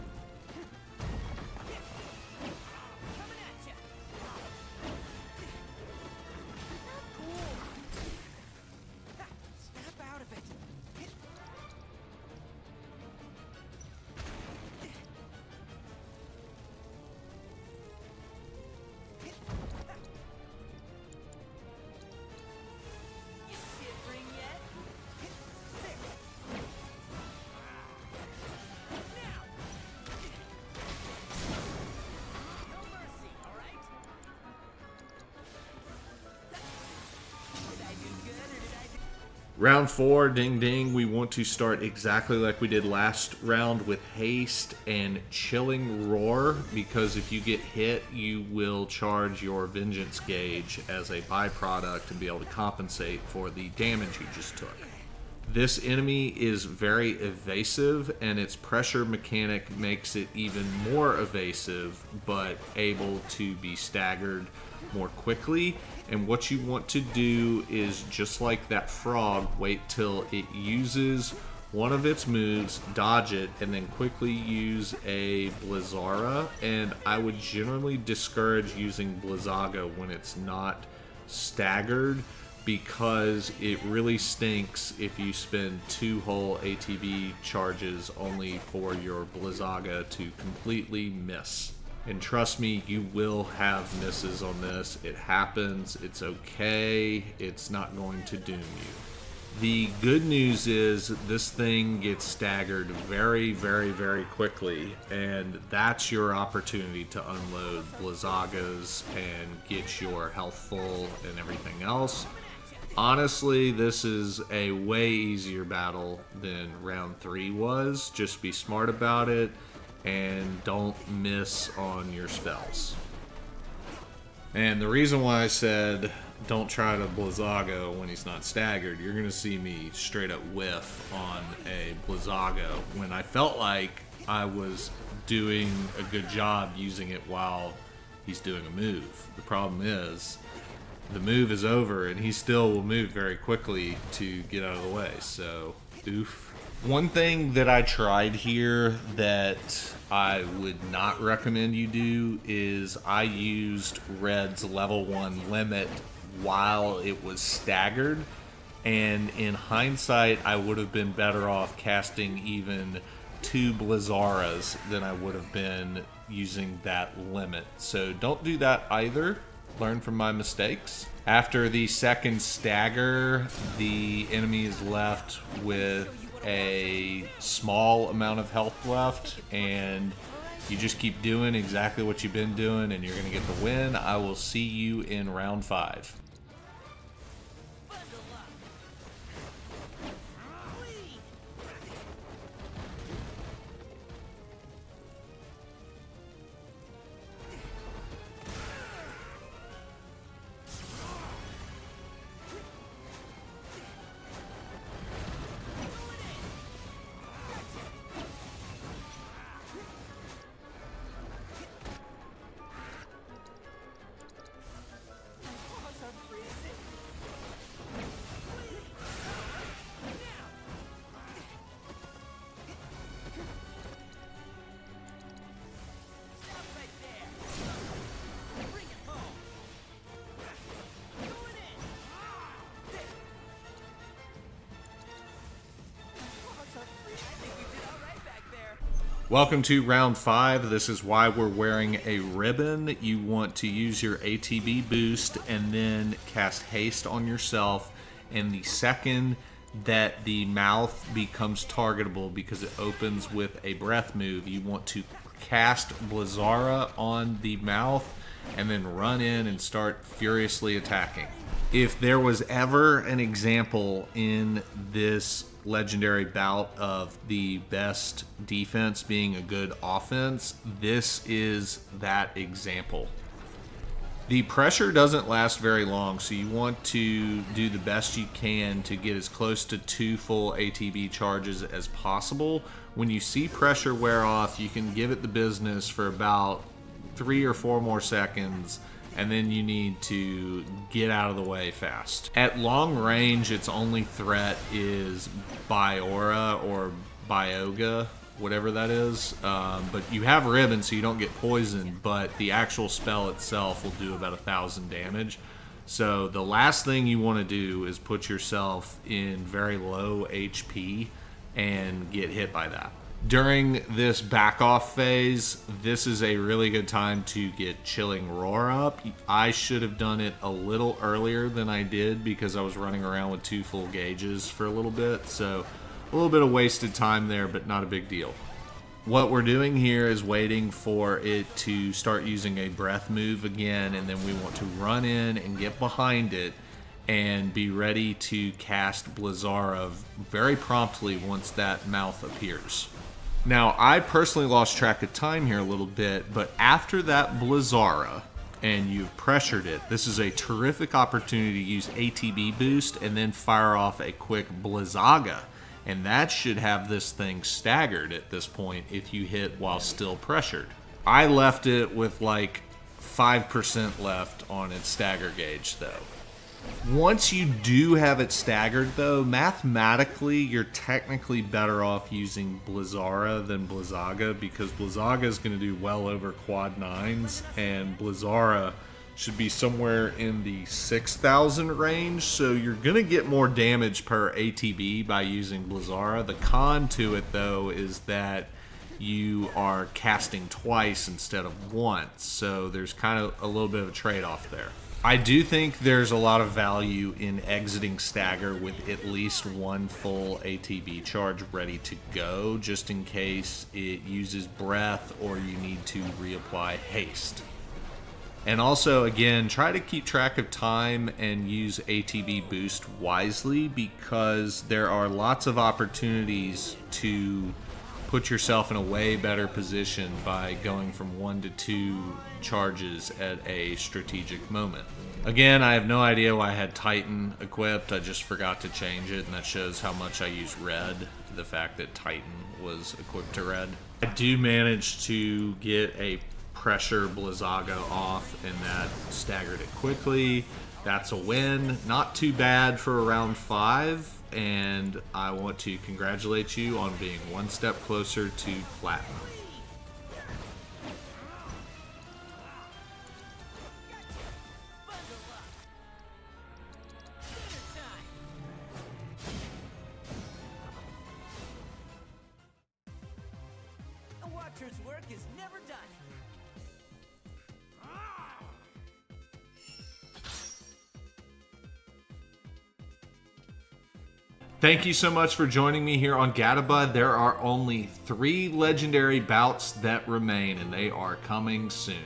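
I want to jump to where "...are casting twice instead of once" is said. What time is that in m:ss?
6:29.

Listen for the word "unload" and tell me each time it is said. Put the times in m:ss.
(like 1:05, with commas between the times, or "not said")
1:47.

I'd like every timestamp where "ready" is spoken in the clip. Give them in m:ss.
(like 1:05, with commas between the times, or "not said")
5:37, 6:41.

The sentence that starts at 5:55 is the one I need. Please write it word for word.
And that should have this thing staggered at this point if you hit while still pressured.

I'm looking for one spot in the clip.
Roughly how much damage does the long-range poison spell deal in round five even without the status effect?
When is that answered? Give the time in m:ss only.
5:04.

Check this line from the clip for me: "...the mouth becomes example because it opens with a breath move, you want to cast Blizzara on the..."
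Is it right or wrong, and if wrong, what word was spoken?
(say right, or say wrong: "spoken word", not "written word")
wrong: "targetable", not "example".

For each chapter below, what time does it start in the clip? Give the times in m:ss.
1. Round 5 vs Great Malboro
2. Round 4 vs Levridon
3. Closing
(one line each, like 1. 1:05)
1. 3:57
2. 0:38
3. 7:53.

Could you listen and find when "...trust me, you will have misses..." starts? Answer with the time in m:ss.
1:32.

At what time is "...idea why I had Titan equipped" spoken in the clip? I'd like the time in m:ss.
7:06.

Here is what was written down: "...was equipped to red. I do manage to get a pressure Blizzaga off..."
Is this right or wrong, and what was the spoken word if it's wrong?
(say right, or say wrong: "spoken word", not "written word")
right.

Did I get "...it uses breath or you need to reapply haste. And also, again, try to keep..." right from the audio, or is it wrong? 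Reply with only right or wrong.
right.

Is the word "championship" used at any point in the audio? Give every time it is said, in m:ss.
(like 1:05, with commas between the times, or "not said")
not said.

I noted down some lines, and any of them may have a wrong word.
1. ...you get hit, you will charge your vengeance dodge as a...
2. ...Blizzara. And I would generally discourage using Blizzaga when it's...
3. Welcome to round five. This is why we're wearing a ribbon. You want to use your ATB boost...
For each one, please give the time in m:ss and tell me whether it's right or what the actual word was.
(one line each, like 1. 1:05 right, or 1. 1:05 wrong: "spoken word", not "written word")
1. 0:47 wrong: "gauge", not "dodge"
2. 1:15 right
3. 3:59 right.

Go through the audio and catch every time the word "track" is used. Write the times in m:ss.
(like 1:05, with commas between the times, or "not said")
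5:44, 6:50.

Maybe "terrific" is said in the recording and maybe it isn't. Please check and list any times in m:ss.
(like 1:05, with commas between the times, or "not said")
5:50.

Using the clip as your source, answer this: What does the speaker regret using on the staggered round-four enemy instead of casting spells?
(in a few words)
Red's level one limit.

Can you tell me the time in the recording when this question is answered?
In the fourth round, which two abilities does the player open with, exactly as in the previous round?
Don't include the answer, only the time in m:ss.
0:44.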